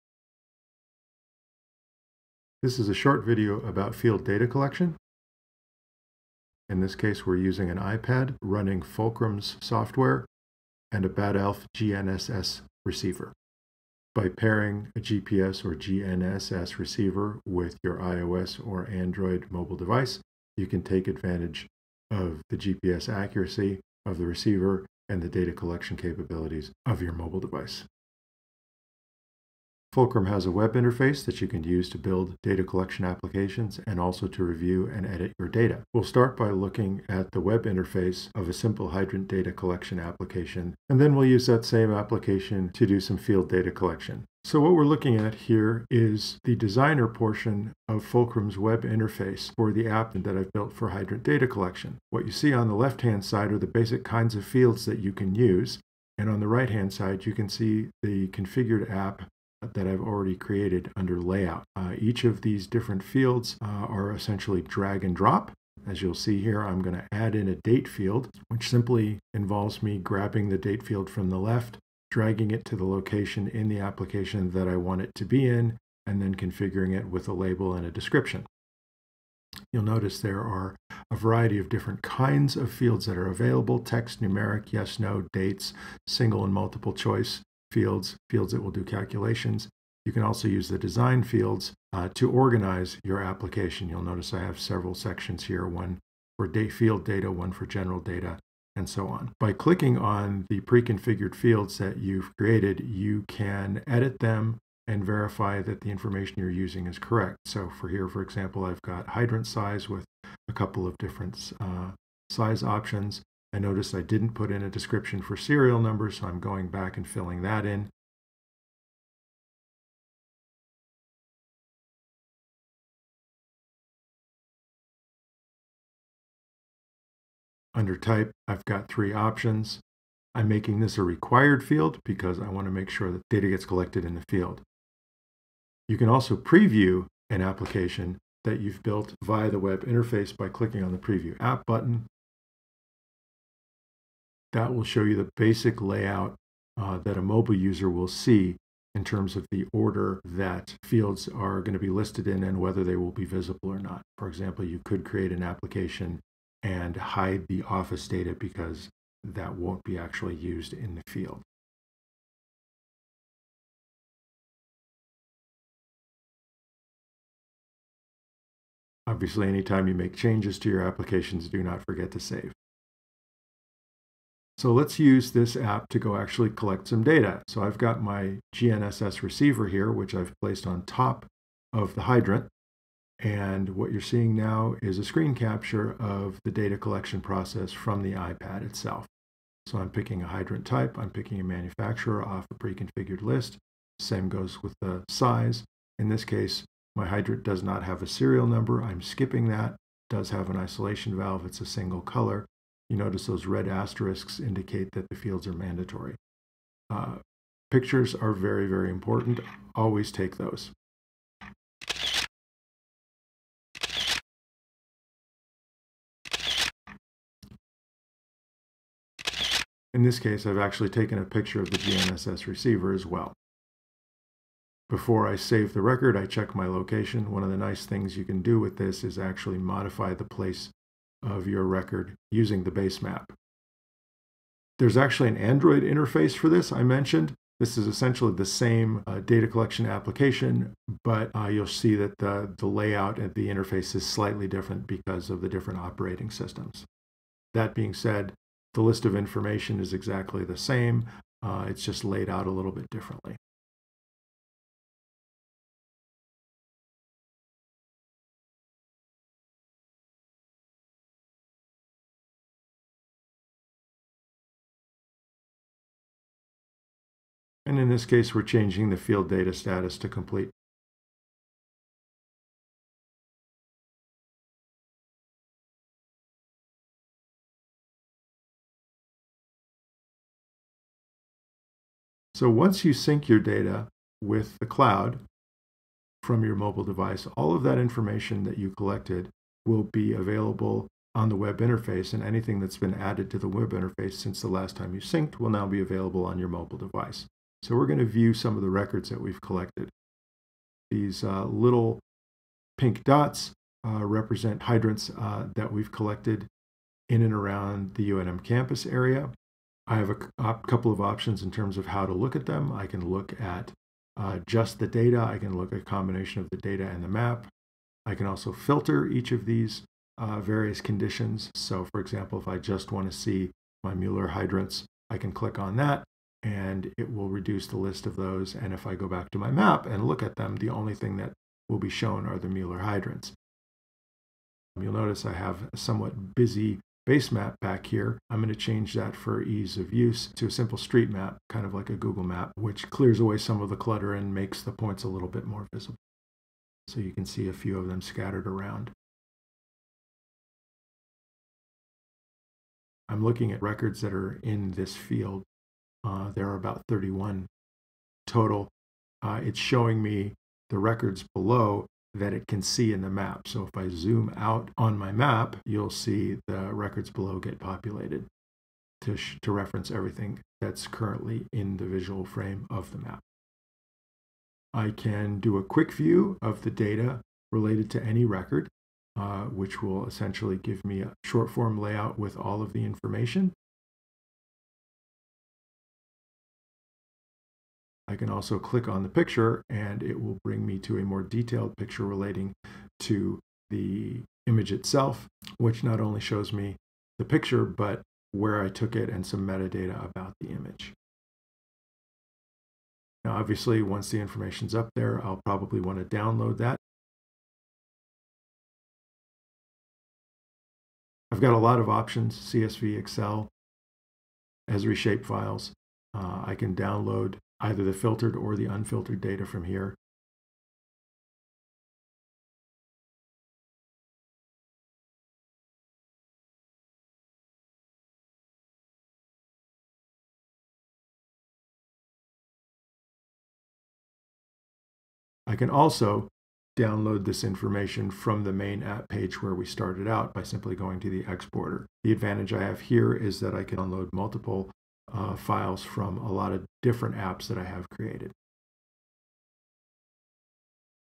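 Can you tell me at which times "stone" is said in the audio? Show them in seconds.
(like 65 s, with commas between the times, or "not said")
not said.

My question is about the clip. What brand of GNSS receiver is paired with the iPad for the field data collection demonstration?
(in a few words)
Bad Elf.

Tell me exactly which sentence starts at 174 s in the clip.
So let's use this app to go actually collect some data.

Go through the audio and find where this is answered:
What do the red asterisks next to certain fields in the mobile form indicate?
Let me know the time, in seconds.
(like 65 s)
205 s.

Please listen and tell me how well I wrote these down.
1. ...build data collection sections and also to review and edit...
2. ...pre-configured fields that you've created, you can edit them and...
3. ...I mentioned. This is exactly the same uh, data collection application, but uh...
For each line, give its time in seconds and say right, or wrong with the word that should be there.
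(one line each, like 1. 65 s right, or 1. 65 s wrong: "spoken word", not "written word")
1. 31 s wrong: "applications", not "sections"
2. 100 s right
3. 236 s wrong: "essentially", not "exactly".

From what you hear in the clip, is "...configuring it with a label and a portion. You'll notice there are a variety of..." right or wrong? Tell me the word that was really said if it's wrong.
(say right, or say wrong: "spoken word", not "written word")
wrong: "description", not "portion".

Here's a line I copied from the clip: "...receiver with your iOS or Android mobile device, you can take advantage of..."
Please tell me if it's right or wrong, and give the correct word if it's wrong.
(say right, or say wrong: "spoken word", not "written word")
right.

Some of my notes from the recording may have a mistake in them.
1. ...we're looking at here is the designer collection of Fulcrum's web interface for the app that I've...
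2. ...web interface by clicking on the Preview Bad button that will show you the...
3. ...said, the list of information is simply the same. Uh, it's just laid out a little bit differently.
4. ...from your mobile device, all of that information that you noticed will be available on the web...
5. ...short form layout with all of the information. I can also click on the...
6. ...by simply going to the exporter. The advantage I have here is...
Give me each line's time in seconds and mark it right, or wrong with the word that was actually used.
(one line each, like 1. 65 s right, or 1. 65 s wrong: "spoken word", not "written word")
1. 44 s wrong: "portion", not "collection"
2. 139 s wrong: "App", not "Bad"
3. 247 s wrong: "exactly", not "simply"
4. 286 s wrong: "collected", not "noticed"
5. 381 s right
6. 440 s right.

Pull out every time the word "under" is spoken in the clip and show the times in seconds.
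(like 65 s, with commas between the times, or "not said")
60 s, 127 s.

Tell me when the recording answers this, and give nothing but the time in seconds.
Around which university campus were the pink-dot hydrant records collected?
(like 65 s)
308 s.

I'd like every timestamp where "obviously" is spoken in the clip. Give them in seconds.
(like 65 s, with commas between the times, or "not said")
169 s, 403 s.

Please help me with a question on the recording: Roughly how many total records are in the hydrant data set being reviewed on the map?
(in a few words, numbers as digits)
31.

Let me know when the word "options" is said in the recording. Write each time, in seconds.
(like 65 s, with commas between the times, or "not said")
112 s, 129 s, 311 s, 411 s.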